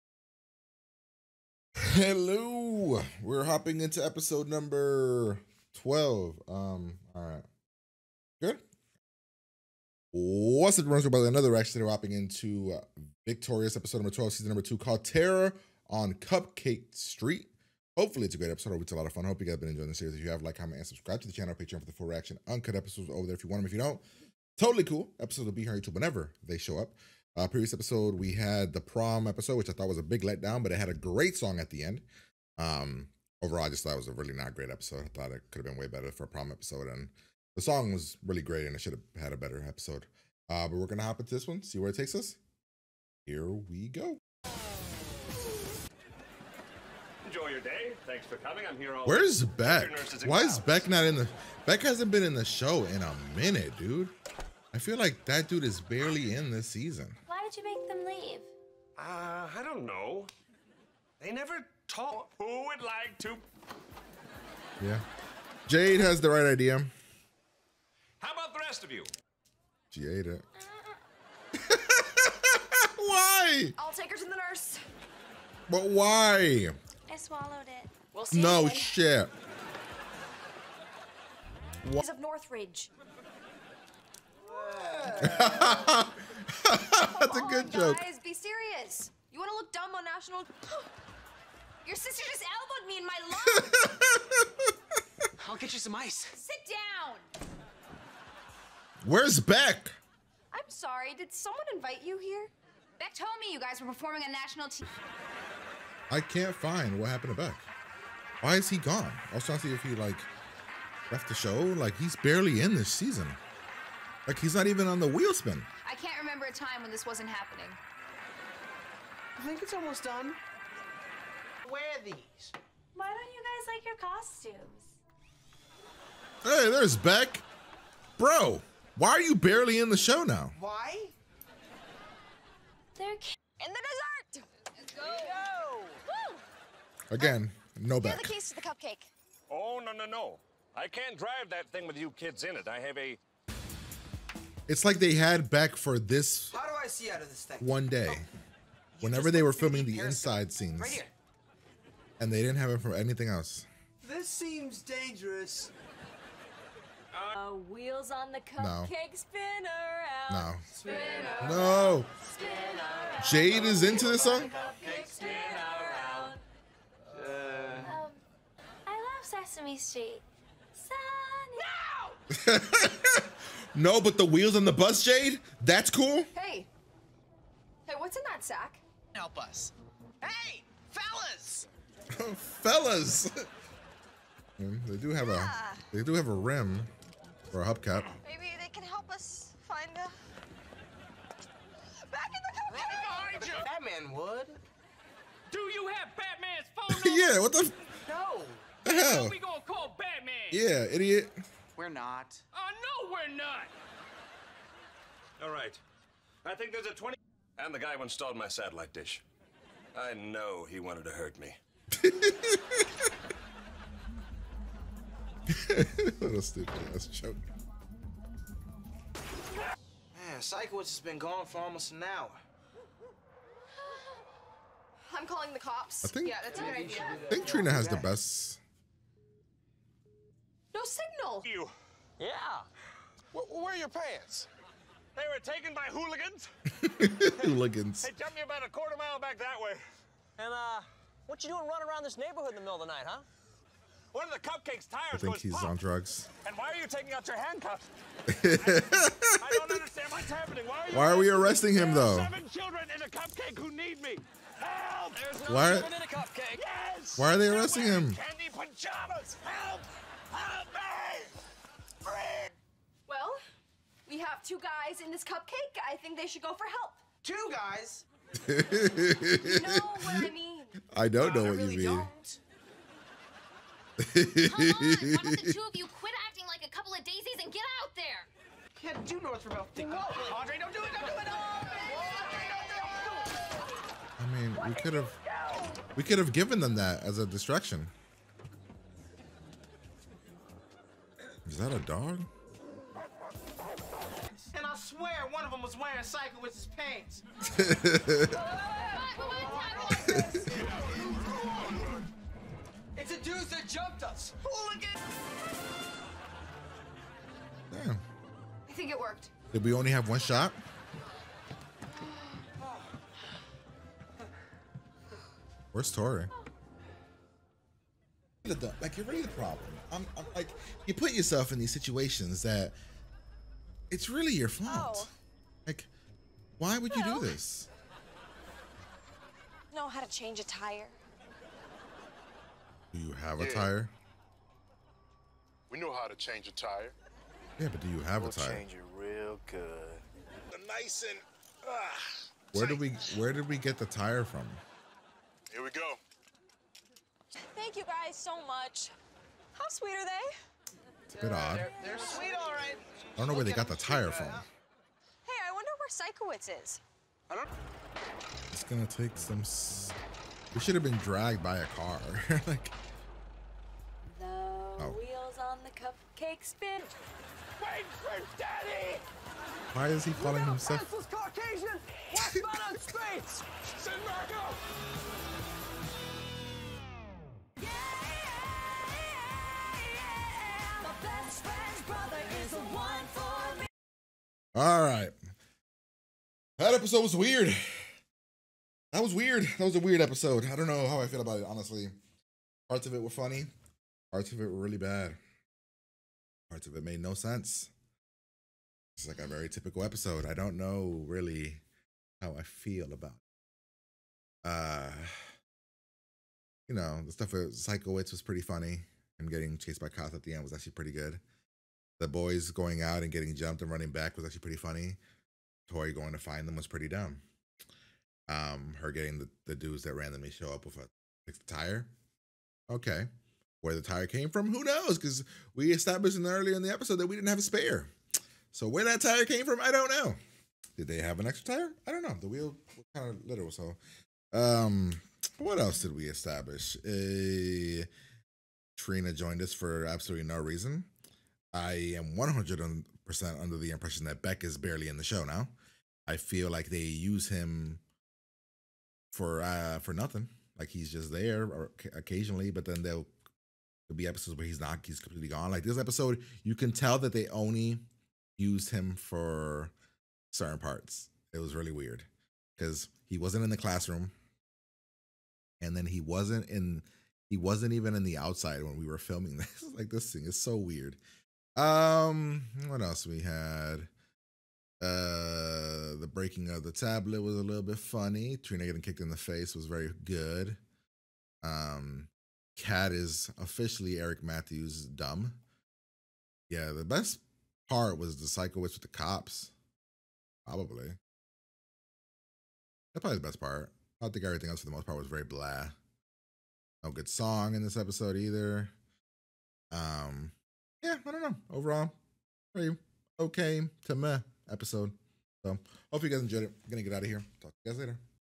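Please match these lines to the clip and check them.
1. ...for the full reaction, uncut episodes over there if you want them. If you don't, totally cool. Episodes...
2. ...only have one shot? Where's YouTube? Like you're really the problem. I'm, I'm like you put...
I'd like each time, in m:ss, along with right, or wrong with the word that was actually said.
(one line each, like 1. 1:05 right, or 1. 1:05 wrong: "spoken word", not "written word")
1. 0:21 right
2. 5:09 wrong: "Tori", not "YouTube".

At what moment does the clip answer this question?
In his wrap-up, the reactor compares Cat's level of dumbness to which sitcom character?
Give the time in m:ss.
8:03.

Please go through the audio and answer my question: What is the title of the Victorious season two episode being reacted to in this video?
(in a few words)
Terror on Cupcake Street.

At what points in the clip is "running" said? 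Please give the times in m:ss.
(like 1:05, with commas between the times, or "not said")
4:01, 6:53.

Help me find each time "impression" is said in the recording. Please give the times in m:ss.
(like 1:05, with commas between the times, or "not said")
7:23.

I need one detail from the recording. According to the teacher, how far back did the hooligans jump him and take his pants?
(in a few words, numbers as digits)
A quarter mile.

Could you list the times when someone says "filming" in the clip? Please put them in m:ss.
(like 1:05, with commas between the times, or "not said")
2:29, 7:48.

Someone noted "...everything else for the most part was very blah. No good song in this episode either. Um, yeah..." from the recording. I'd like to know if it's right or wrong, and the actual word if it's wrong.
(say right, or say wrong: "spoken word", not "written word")
right.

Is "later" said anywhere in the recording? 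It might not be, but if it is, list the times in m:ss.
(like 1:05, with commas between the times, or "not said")
8:27.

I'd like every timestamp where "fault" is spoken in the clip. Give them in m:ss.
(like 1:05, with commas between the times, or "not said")
5:24.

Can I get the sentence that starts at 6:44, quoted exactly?
Uh, you know, the stuff with Sikowitz was pretty funny.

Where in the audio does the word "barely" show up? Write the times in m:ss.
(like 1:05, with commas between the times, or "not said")
0:55, 1:52, 2:09, 7:24.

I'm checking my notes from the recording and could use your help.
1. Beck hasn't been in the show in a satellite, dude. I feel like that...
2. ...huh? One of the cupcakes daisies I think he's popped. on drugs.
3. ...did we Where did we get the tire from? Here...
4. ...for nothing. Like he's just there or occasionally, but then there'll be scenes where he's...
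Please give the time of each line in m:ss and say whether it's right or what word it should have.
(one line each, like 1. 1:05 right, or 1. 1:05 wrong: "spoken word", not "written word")
1. 0:51 wrong: "minute", not "satellite"
2. 4:03 wrong: "tires", not "daisies"
3. 5:42 right
4. 7:29 wrong: "episodes", not "scenes".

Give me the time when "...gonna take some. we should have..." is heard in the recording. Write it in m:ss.
5:58.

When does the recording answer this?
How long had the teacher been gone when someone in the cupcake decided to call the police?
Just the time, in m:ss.
3:41.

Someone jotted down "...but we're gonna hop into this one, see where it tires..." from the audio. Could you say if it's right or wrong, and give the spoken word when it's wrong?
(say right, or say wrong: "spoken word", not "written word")
wrong: "takes", not "tires".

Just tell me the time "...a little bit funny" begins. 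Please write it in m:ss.
7:57.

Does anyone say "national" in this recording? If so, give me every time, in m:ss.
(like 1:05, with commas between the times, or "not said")
1:30, 1:44.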